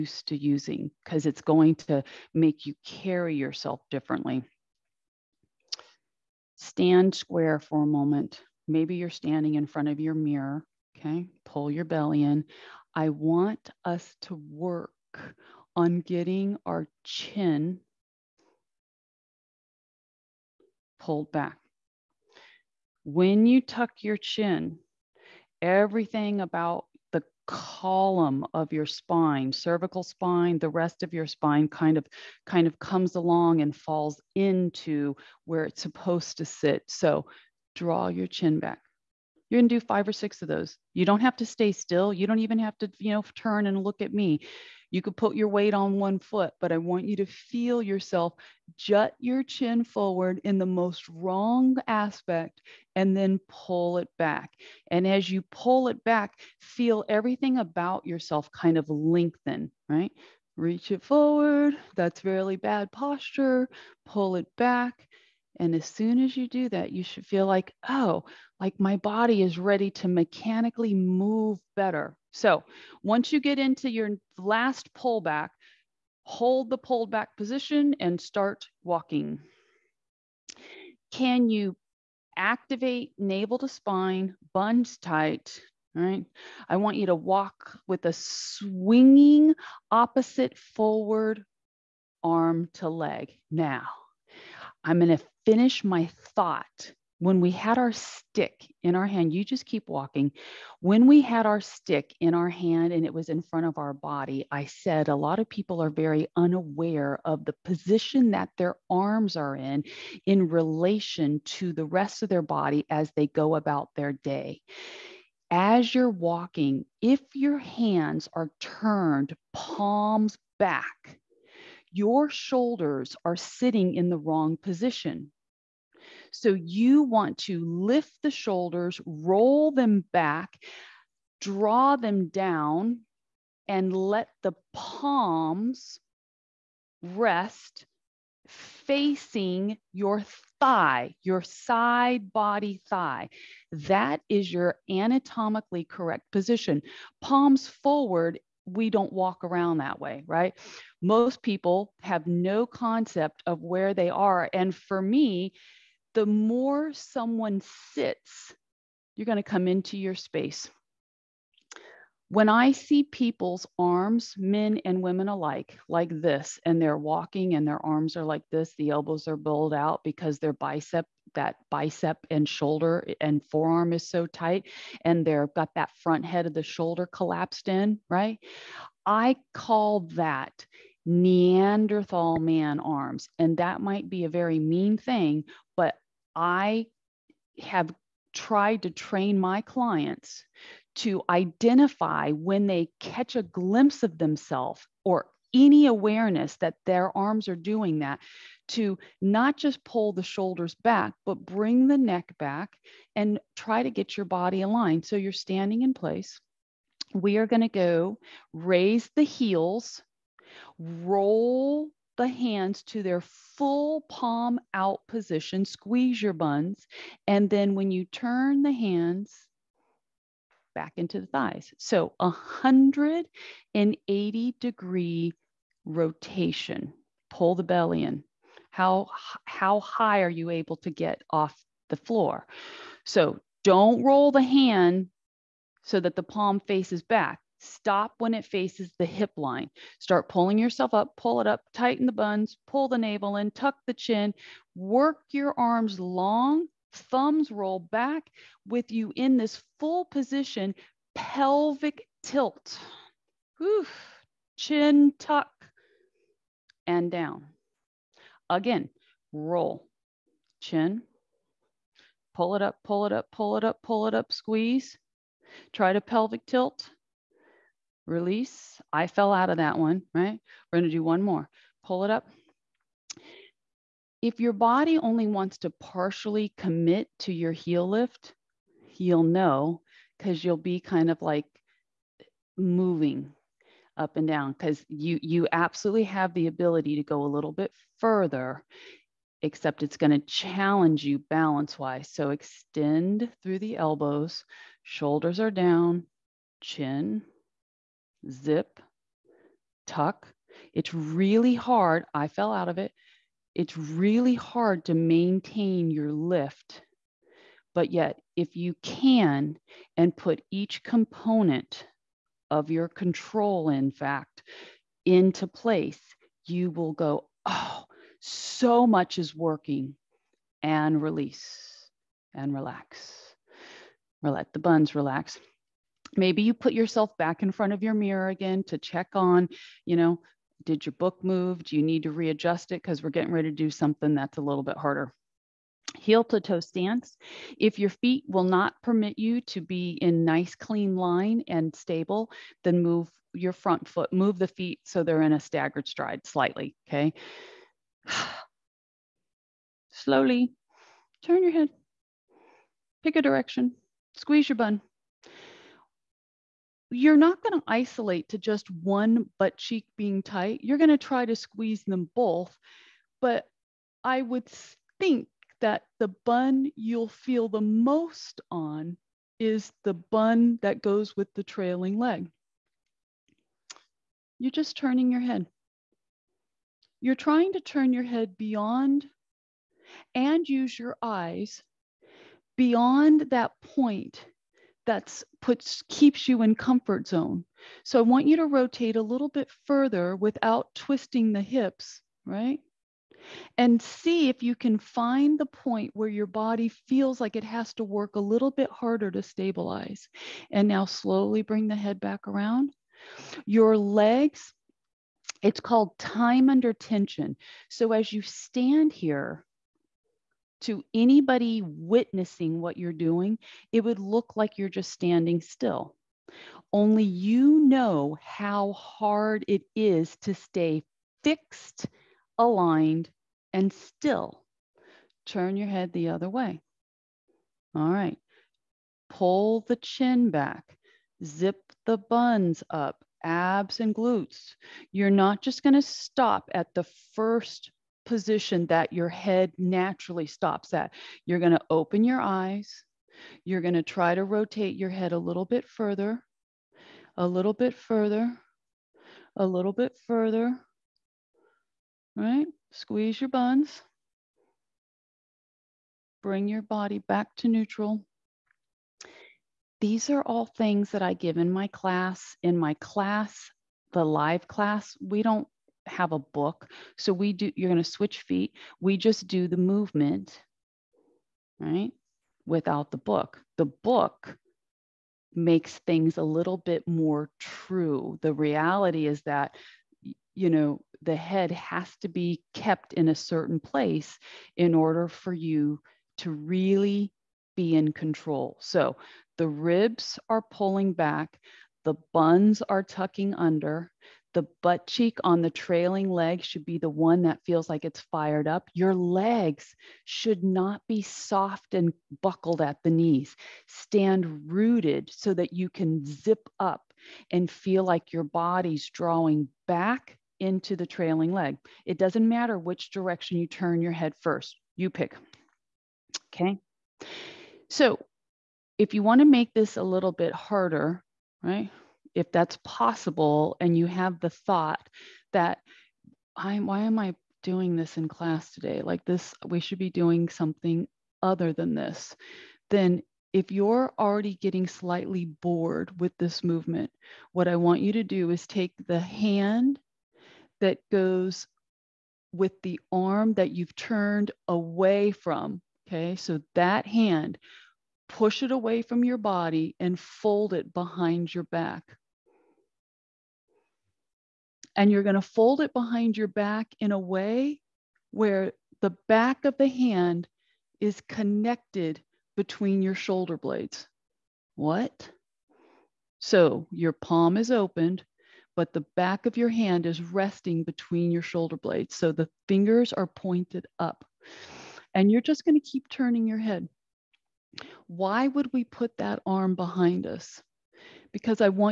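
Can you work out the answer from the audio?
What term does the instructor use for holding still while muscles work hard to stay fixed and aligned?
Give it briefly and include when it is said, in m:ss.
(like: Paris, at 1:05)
time under tension, at 6:45.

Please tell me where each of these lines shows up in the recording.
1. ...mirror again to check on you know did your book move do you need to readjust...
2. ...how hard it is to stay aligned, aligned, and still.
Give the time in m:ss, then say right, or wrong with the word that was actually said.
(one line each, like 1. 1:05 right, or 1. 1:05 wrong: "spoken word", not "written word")
1. 5:27 right
2. 6:58 wrong: "fixed", not "aligned".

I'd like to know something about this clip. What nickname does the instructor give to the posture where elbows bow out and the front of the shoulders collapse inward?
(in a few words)
Neanderthal man arms.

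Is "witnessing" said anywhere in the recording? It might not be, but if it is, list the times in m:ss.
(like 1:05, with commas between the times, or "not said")
6:51.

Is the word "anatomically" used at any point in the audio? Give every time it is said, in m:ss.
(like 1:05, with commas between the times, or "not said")
2:24.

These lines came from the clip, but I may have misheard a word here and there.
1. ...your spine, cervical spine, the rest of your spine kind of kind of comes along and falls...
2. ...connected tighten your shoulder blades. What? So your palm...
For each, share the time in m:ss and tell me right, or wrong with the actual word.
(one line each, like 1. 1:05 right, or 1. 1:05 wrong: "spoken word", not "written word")
1. 0:28 right
2. 9:21 wrong: "between", not "tighten".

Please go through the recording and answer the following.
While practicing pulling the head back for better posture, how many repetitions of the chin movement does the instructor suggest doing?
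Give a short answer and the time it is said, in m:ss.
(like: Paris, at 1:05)
5 or 6, at 0:39.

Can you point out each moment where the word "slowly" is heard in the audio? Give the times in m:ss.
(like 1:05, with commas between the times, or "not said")
5:49, 6:40.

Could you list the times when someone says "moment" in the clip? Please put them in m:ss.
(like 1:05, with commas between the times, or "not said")
0:07.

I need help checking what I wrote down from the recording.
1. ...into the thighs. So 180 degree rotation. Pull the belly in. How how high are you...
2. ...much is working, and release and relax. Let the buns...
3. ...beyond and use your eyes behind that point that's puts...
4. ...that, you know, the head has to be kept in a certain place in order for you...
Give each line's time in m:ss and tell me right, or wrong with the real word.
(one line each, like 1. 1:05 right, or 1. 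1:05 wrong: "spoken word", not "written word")
1. 3:40 right
2. 5:18 right
3. 6:18 wrong: "beyond", not "behind"
4. 7:59 right.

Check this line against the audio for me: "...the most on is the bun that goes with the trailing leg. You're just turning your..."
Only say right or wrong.
right.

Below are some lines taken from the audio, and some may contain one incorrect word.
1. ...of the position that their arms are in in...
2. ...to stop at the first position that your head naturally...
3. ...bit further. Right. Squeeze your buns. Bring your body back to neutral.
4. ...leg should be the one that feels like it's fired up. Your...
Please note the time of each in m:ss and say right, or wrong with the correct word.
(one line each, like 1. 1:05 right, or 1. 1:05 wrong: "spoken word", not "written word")
1. 1:47 right
2. 7:15 right
3. 7:29 right
4. 8:16 right.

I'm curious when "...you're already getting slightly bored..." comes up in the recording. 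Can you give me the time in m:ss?
8:53.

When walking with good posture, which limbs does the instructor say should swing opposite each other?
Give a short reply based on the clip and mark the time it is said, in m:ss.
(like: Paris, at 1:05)
arm to leg, at 1:32.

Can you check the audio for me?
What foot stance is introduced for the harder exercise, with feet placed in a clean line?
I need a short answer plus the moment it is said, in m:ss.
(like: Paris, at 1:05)
heel to toe stance, at 5:35.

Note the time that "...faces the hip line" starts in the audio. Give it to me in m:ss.
3:58.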